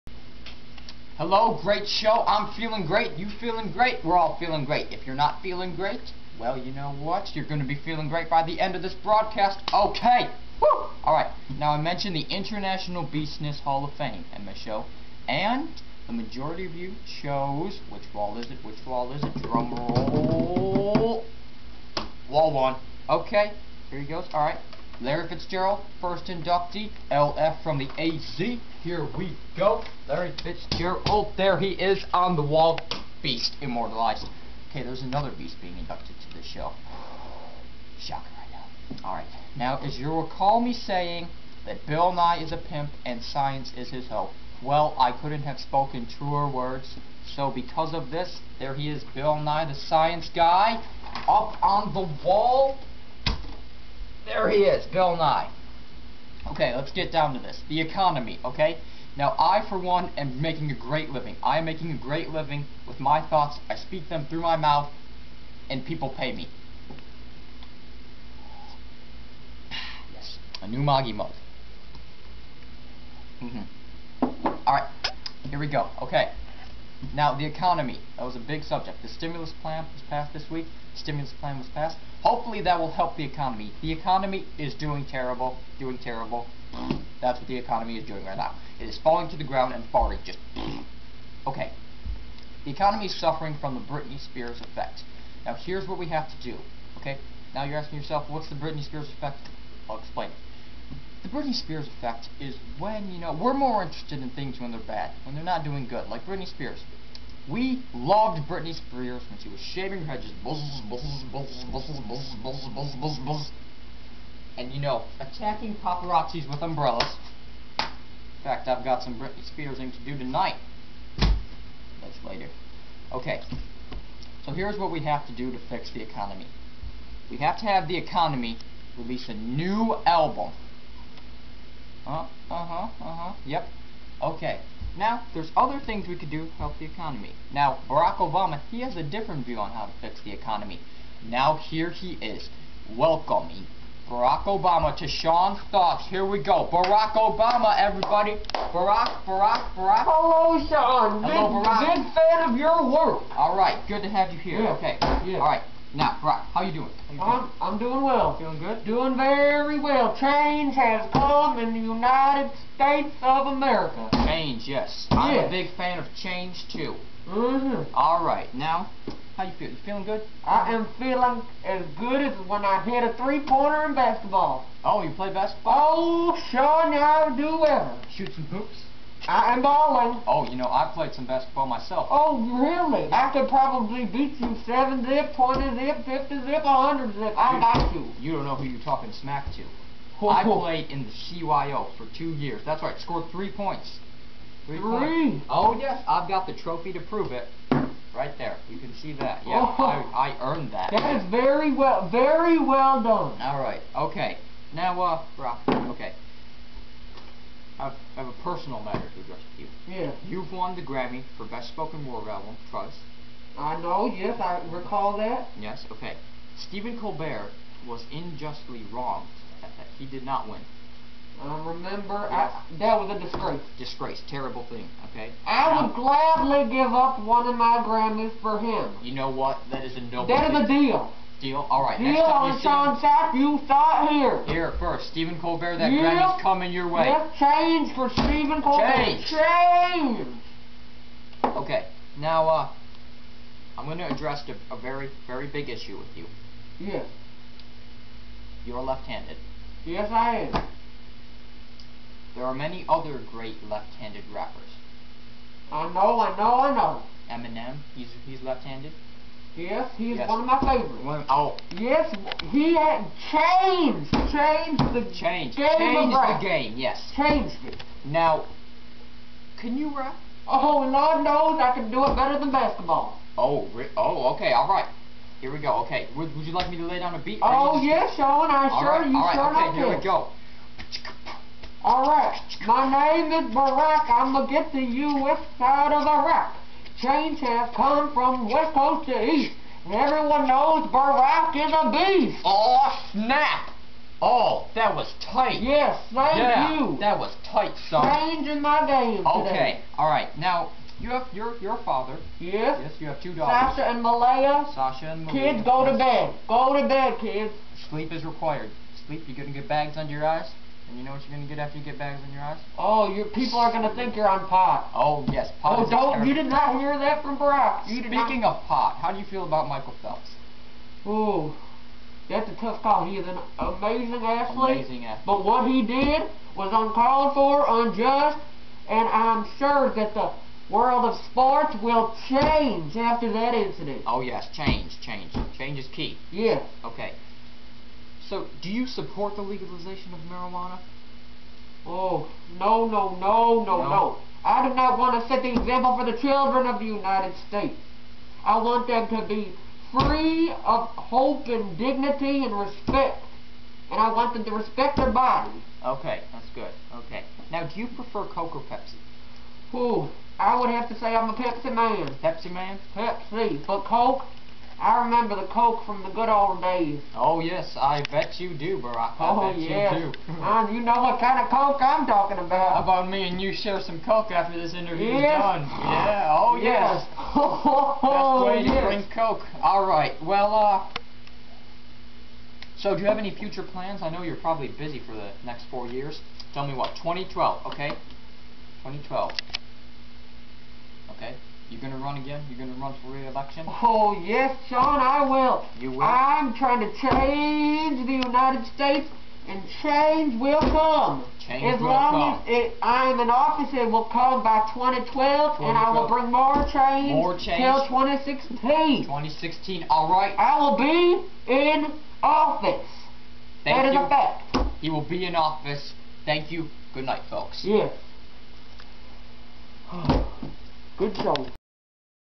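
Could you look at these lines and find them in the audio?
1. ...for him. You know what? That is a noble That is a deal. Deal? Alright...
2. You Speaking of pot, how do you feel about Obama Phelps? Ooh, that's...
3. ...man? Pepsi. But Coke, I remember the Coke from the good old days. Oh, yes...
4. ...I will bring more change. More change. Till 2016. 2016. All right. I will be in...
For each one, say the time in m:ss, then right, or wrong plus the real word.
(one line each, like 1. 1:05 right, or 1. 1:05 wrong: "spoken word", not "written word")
1. 3:48 right
2. 5:17 wrong: "Michael", not "Obama"
3. 6:02 right
4. 6:45 right.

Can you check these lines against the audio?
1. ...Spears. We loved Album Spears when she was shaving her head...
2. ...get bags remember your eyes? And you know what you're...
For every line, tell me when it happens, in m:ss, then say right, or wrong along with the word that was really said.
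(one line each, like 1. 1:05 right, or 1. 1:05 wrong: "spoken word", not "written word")
1. 1:46 wrong: "Britney", not "Album"
2. 5:09 wrong: "under", not "remember".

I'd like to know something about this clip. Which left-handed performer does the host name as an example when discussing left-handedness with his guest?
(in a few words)
Eminem.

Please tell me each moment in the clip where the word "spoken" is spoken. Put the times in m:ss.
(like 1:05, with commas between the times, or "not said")
0:45, 3:31.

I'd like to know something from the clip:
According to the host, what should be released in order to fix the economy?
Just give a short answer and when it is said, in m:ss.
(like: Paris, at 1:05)
a new album, at 2:08.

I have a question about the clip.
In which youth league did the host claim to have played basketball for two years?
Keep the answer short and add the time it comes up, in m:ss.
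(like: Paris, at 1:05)
CYO, at 3:11.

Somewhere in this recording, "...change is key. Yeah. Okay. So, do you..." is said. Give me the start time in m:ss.
5:35.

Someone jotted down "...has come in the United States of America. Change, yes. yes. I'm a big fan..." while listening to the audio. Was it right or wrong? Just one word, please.
right.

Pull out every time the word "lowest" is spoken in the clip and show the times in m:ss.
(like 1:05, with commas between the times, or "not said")
not said.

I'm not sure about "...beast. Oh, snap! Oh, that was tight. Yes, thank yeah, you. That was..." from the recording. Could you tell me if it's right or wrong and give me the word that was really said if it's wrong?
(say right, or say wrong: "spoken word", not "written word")
right.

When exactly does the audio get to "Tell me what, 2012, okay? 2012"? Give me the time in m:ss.
6:26.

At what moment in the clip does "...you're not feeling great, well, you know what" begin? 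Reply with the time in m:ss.
0:05.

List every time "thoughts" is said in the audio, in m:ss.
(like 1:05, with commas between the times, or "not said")
1:03, 2:25, 3:53.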